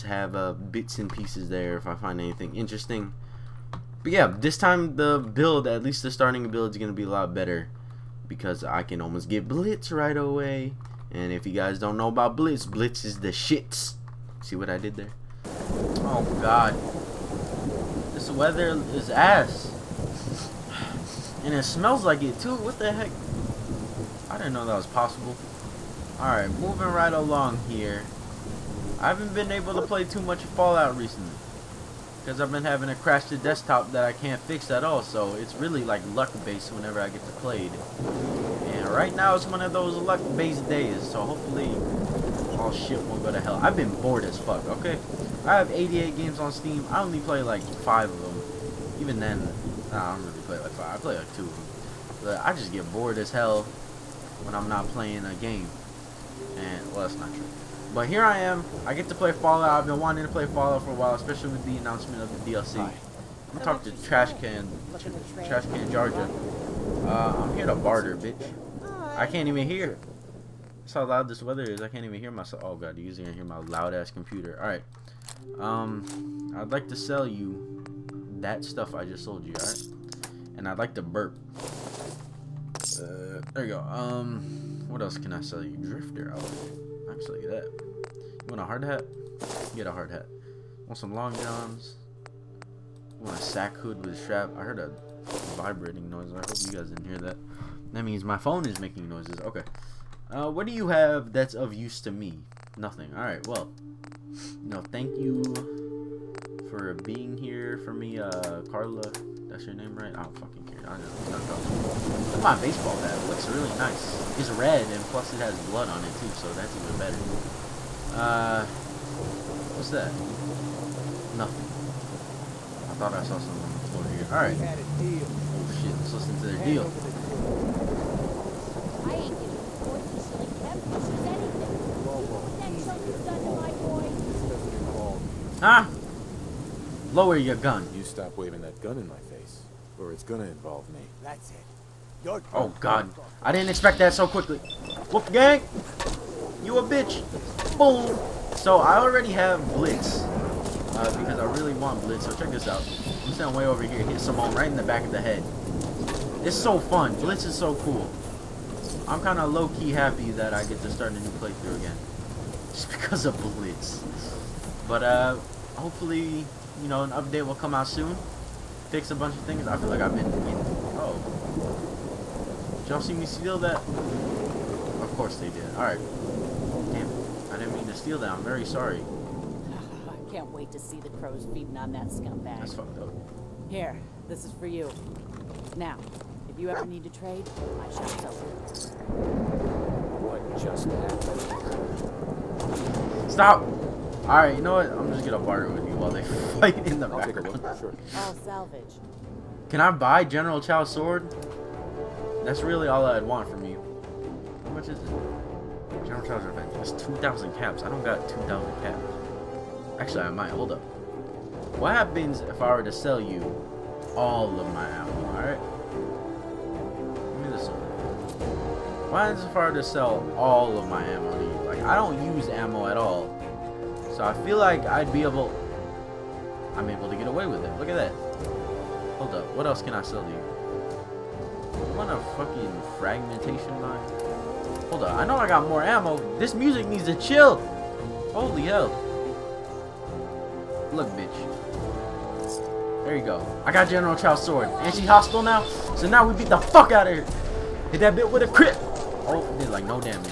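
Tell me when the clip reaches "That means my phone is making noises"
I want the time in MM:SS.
01:37.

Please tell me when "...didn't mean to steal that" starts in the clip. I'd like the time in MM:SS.
02:57.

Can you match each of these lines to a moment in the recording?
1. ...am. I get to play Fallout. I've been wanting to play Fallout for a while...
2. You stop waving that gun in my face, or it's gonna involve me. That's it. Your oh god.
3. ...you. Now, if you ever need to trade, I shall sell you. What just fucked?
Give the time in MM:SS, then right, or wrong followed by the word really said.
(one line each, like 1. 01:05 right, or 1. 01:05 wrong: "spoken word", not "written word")
1. 00:58 right
2. 02:17 right
3. 03:04 wrong: "happened", not "fucked".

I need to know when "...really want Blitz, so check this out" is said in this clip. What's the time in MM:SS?
02:31.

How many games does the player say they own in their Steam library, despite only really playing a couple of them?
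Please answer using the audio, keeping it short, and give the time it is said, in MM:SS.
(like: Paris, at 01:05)
88, at 00:45.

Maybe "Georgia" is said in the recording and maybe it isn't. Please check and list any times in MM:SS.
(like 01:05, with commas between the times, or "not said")
01:05.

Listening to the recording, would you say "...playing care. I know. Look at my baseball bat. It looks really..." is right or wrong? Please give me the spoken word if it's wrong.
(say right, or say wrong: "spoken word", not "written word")
wrong: "fucking", not "playing".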